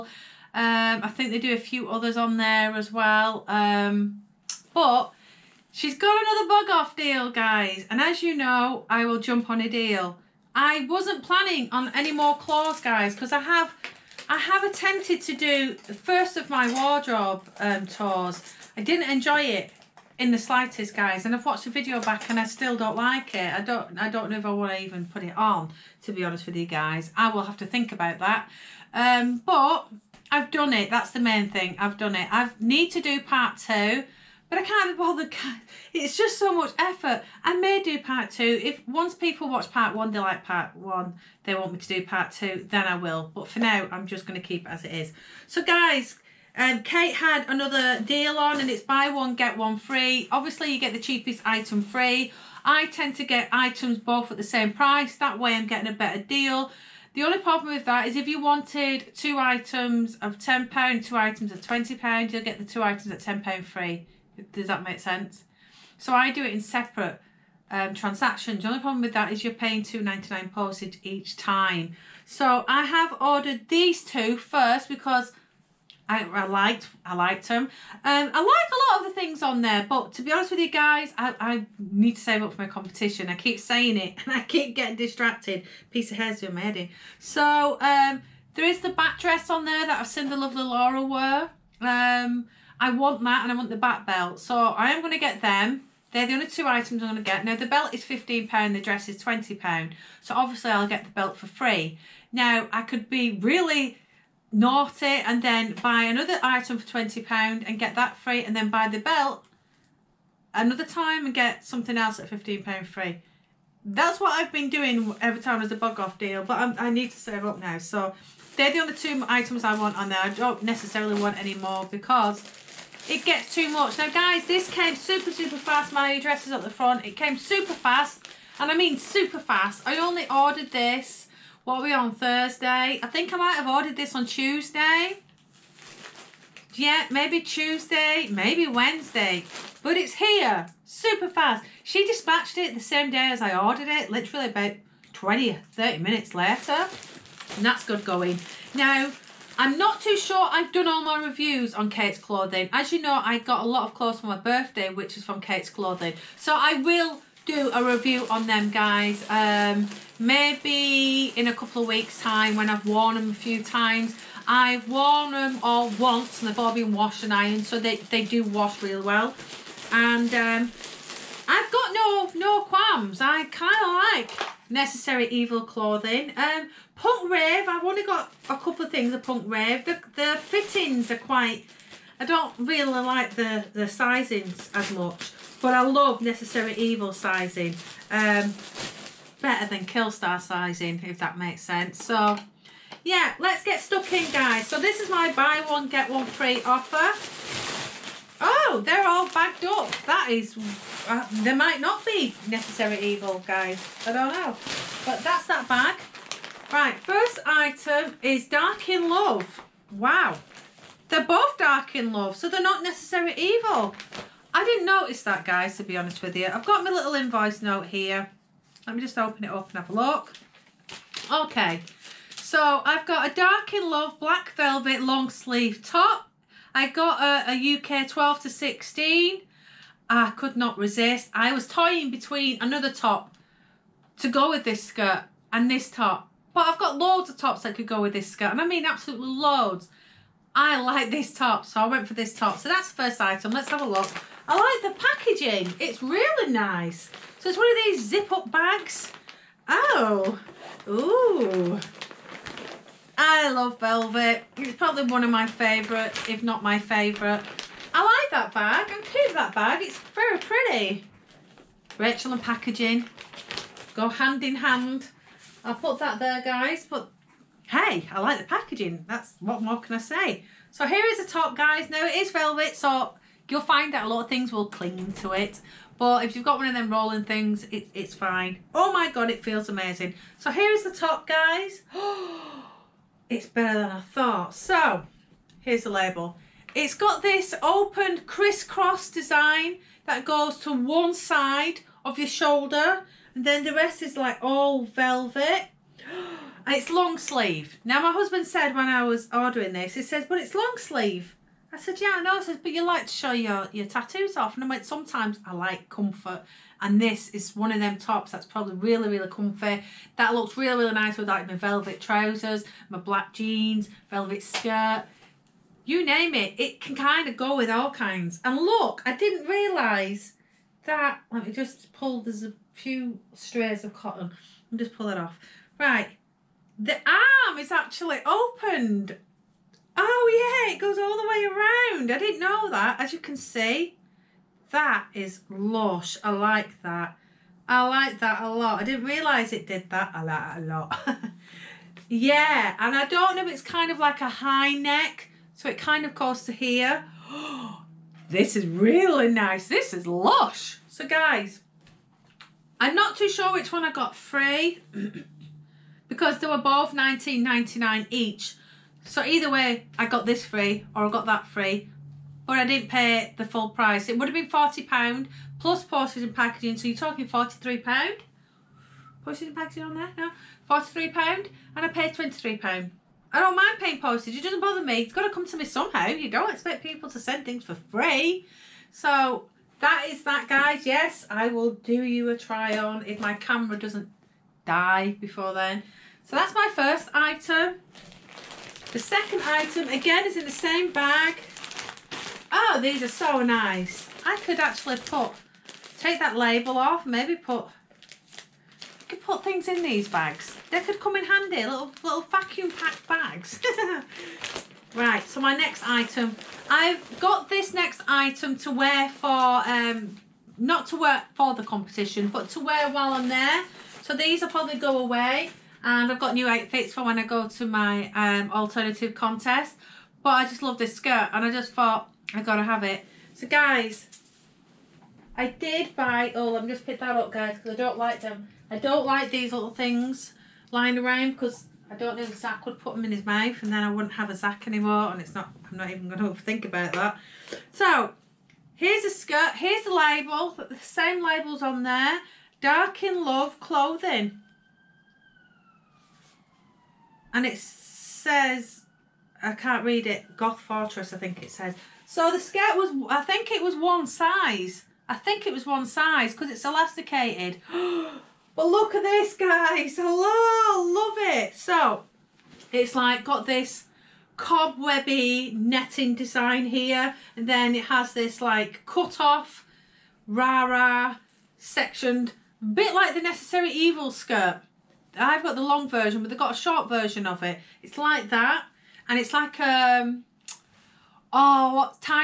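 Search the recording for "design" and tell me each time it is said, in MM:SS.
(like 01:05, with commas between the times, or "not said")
04:49, 07:46.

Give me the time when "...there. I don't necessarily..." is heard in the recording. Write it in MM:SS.
02:00.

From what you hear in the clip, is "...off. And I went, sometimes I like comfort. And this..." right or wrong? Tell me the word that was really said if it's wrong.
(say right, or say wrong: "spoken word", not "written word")
right.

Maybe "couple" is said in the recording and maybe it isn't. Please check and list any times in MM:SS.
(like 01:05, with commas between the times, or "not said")
02:41, 02:58.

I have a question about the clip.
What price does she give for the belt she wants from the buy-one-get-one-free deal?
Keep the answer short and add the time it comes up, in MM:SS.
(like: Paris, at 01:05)
£15, at 01:37.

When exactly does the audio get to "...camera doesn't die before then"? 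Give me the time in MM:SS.
06:23.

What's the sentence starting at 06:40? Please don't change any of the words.
They could come in handy, little, little vacuum pack bags.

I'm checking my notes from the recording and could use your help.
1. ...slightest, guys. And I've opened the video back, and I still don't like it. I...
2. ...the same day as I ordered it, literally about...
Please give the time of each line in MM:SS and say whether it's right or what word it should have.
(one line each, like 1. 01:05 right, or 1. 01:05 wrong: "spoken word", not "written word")
1. 00:20 wrong: "watched", not "opened"
2. 02:22 right.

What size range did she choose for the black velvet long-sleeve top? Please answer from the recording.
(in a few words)
UK 12 to 16.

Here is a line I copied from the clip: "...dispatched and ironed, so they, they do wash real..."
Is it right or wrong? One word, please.
wrong.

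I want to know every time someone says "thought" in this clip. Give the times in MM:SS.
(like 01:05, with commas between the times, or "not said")
04:43, 07:01.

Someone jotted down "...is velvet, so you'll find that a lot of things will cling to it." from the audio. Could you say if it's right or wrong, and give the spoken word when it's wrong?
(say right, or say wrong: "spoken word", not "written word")
right.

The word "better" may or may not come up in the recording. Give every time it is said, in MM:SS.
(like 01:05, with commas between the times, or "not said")
00:55, 03:09, 04:43.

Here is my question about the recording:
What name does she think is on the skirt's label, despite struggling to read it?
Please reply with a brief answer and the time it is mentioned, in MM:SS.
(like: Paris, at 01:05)
Goth Fortress, at 07:30.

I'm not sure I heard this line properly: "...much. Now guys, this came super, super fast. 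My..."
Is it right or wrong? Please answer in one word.
right.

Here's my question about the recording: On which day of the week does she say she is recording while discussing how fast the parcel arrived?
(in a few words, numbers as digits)
Thursday.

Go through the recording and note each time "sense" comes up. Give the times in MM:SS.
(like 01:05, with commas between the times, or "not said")
01:04, 03:11.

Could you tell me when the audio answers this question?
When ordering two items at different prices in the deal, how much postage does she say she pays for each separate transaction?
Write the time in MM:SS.
01:09.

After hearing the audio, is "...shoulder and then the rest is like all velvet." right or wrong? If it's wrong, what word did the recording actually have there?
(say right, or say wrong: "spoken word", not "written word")
right.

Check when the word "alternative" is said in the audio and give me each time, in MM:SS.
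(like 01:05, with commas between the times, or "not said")
06:58.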